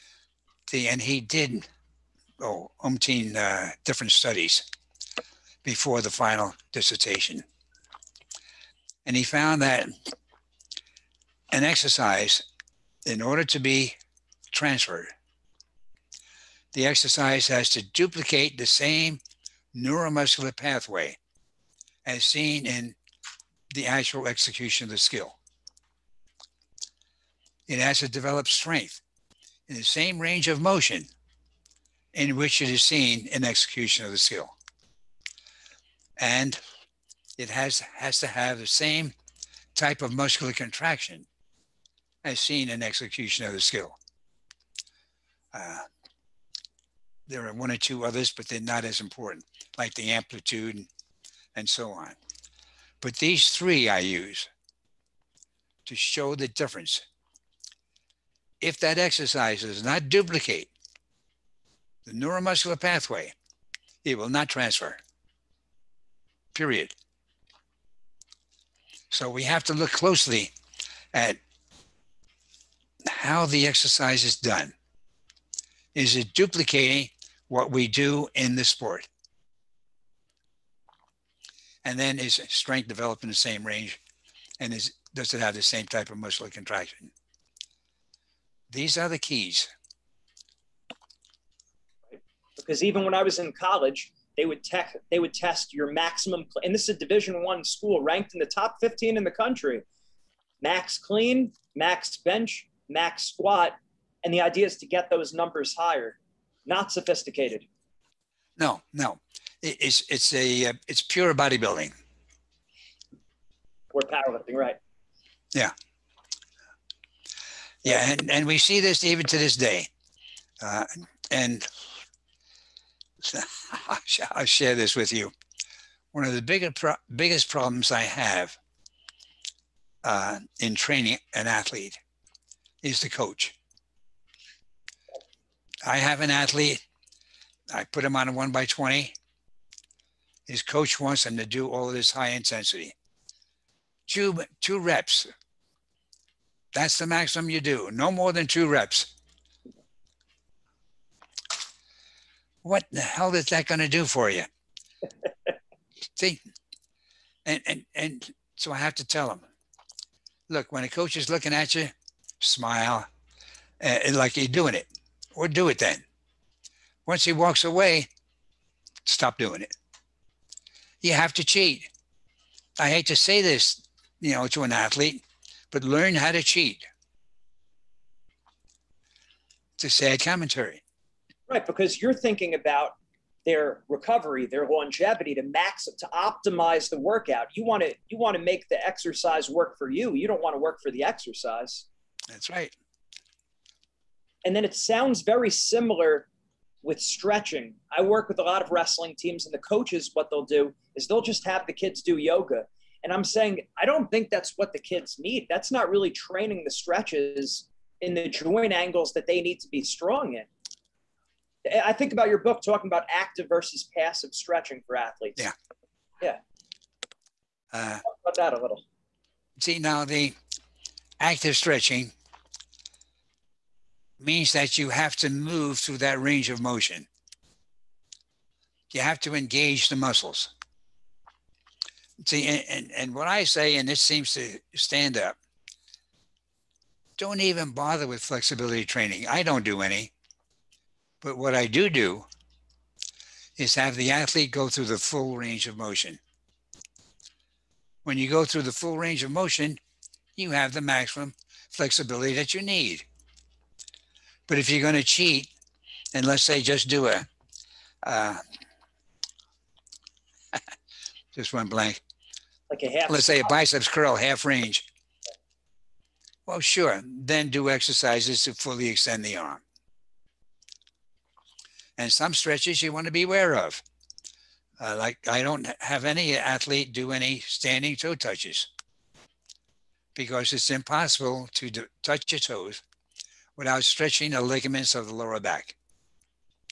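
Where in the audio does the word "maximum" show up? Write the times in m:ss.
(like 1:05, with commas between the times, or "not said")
1:35, 2:27, 4:10.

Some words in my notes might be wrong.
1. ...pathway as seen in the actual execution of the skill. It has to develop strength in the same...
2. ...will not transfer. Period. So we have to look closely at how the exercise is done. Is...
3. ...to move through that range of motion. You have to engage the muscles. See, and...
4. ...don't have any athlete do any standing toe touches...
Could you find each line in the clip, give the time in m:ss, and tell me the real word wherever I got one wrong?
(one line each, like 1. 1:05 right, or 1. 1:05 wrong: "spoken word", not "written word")
1. 0:20 right
2. 1:04 right
3. 3:45 right
4. 4:35 right.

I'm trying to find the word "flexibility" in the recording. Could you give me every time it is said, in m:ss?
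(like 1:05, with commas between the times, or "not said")
3:58, 4:11.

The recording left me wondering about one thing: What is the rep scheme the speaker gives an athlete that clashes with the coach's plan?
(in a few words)
One by 20.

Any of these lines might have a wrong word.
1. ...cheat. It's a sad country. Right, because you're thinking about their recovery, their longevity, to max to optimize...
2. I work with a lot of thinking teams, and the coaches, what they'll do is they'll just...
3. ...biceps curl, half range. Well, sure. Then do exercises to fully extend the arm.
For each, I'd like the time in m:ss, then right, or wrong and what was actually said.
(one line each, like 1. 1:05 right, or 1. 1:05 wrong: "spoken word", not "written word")
1. 2:56 wrong: "commentary", not "country"
2. 3:17 wrong: "wrestling", not "thinking"
3. 4:23 right.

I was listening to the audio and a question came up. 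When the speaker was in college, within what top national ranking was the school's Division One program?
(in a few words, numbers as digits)
15.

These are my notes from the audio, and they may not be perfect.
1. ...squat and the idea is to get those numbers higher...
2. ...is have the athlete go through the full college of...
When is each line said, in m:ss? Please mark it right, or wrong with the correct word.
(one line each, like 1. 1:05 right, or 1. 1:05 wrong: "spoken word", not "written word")
1. 1:43 right
2. 4:03 wrong: "range", not "college".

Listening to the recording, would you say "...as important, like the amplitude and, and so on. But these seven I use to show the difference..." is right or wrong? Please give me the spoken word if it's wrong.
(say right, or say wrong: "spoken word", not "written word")
wrong: "three", not "seven".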